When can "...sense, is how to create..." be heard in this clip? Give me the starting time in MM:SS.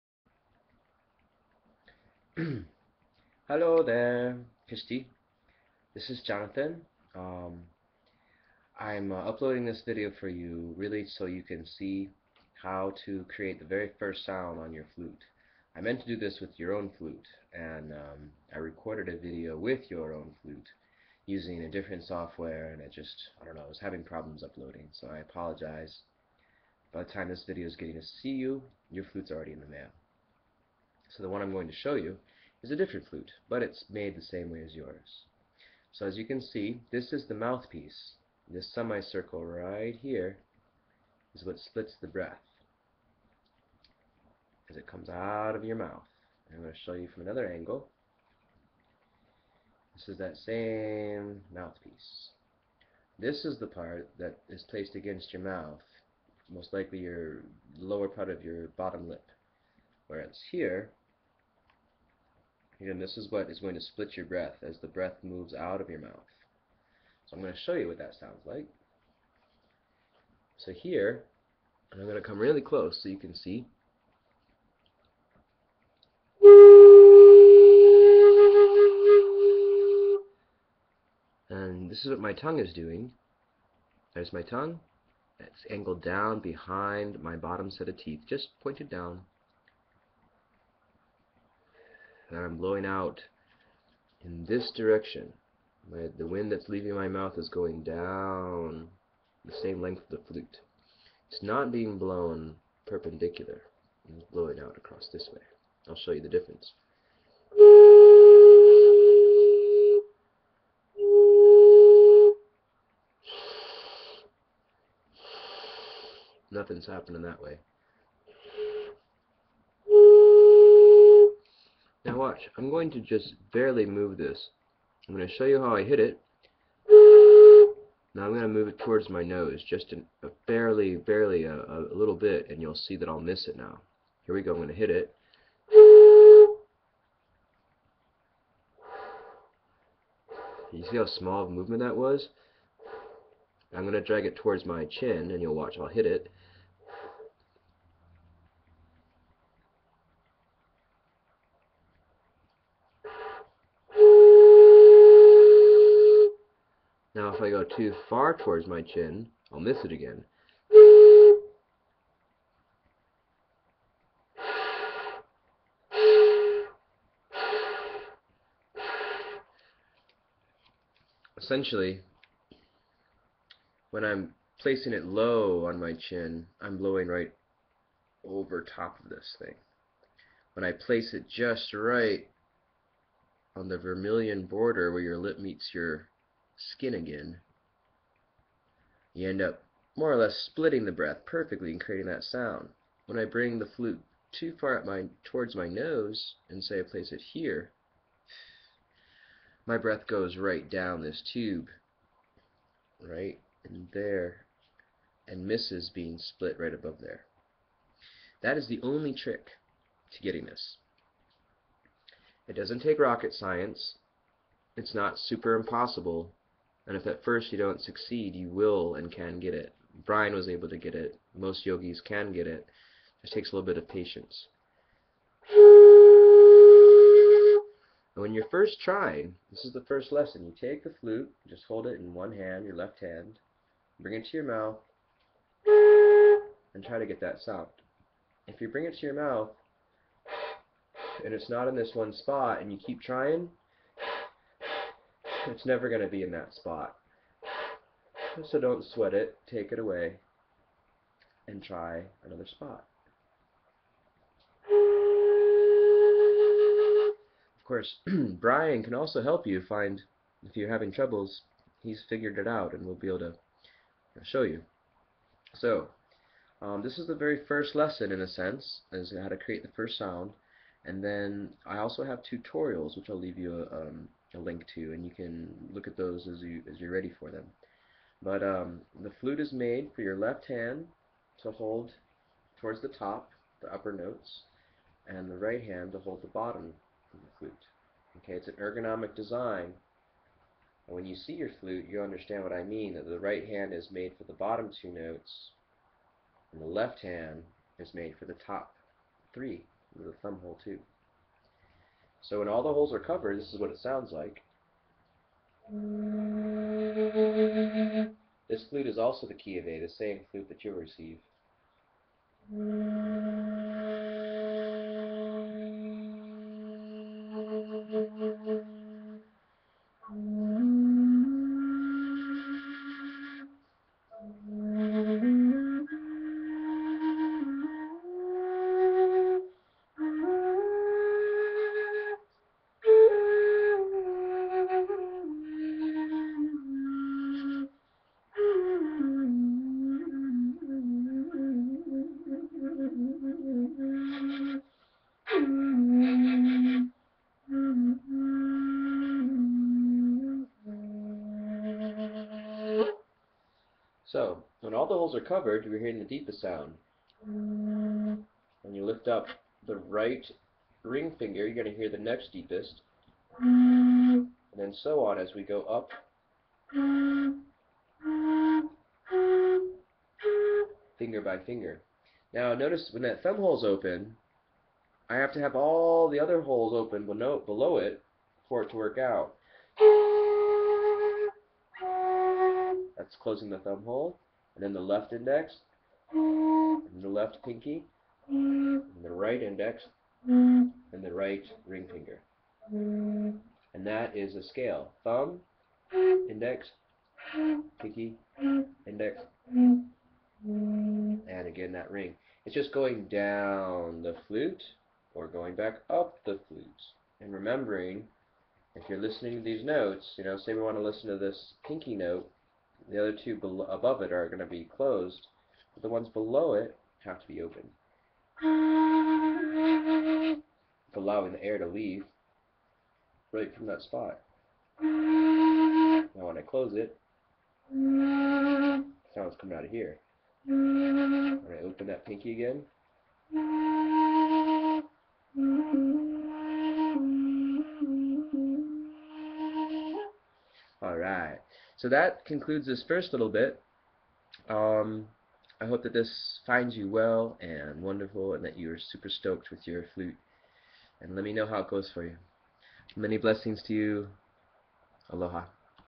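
04:28.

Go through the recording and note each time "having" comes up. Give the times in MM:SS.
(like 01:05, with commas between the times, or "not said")
00:23, 04:20.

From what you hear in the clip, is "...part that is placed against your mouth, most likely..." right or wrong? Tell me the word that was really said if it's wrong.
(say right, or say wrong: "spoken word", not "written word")
right.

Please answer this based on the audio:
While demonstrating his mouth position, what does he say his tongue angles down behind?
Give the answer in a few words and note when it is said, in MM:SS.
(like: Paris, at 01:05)
bottom set of teeth, at 01:27.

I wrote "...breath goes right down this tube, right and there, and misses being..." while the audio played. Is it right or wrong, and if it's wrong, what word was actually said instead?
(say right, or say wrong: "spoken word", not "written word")
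right.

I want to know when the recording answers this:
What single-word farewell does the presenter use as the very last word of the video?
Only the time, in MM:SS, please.
07:35.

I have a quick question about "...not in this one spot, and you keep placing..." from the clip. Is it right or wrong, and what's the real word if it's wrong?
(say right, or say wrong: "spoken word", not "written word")
wrong: "trying", not "placing".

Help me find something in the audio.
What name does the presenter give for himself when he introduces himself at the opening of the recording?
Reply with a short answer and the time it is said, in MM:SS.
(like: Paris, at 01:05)
Jonathan, at 00:06.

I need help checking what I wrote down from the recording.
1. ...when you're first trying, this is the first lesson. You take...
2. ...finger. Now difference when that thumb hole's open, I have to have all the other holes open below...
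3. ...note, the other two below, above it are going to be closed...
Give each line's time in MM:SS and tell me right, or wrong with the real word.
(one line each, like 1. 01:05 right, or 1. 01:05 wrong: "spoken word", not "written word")
1. 03:48 right
2. 06:11 wrong: "notice", not "difference"
3. 06:51 right.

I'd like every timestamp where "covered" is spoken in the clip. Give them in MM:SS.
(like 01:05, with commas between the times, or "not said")
05:02, 05:55.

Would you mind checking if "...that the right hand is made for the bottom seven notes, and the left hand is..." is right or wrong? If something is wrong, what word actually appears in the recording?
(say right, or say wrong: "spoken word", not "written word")
wrong: "two", not "seven".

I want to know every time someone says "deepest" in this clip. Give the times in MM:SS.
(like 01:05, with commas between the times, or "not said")
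05:56, 06:02.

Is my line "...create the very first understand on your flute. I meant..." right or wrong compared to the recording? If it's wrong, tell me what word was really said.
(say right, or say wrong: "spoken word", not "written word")
wrong: "sound", not "understand".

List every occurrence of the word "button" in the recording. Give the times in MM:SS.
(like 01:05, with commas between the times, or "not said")
not said.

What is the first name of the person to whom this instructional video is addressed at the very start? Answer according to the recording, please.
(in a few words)
Christy.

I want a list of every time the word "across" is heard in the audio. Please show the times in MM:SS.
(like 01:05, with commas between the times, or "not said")
01:44.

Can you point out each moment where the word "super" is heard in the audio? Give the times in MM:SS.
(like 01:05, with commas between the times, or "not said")
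03:35, 07:28.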